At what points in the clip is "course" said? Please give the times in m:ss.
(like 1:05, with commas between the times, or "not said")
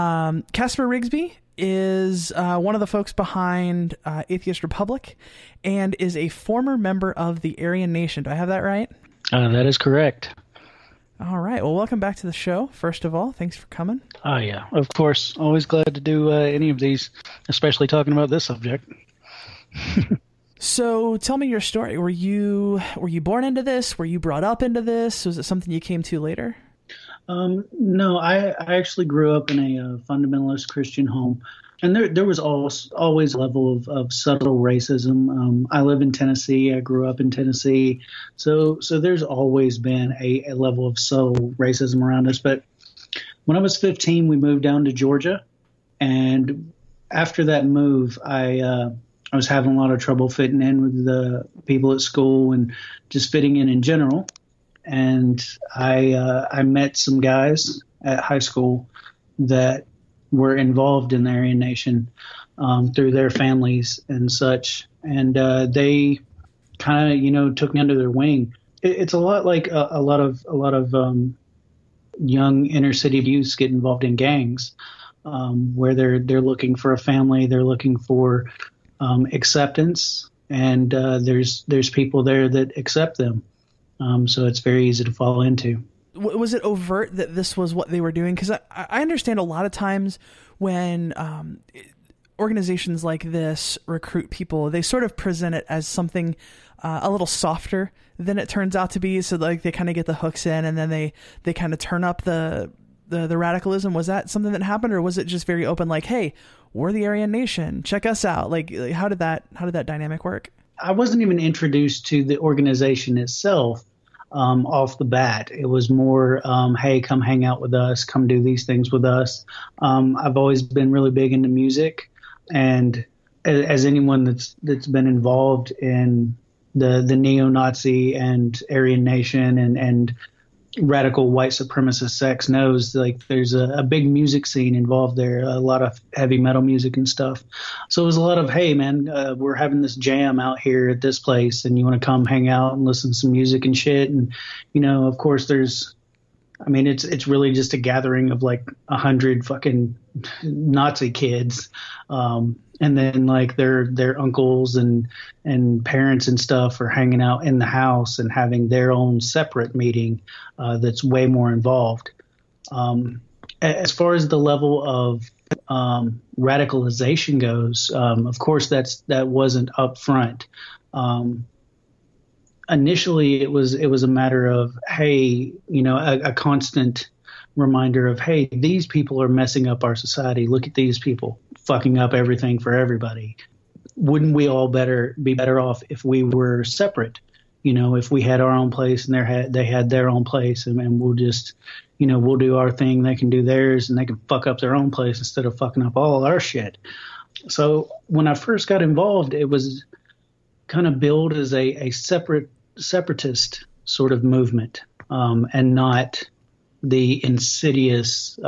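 0:14, 2:25, 2:48.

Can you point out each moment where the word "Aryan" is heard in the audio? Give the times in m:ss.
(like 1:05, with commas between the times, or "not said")
0:07, 1:01, 1:47, 2:08.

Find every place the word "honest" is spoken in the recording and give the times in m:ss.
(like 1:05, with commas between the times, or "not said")
not said.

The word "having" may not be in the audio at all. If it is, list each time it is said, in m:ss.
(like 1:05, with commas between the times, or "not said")
0:49, 2:19, 2:38.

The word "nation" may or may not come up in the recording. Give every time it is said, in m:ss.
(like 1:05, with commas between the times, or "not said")
0:07, 1:01, 1:47, 2:09.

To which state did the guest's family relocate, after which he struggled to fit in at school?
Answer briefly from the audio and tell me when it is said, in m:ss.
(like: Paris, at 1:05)
Georgia, at 0:44.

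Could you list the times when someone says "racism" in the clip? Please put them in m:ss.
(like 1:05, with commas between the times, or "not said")
0:34, 0:41.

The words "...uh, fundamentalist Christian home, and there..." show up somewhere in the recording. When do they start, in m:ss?
0:29.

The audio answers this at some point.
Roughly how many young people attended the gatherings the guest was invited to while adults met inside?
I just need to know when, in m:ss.
2:28.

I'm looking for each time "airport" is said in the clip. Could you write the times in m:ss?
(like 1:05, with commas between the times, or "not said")
not said.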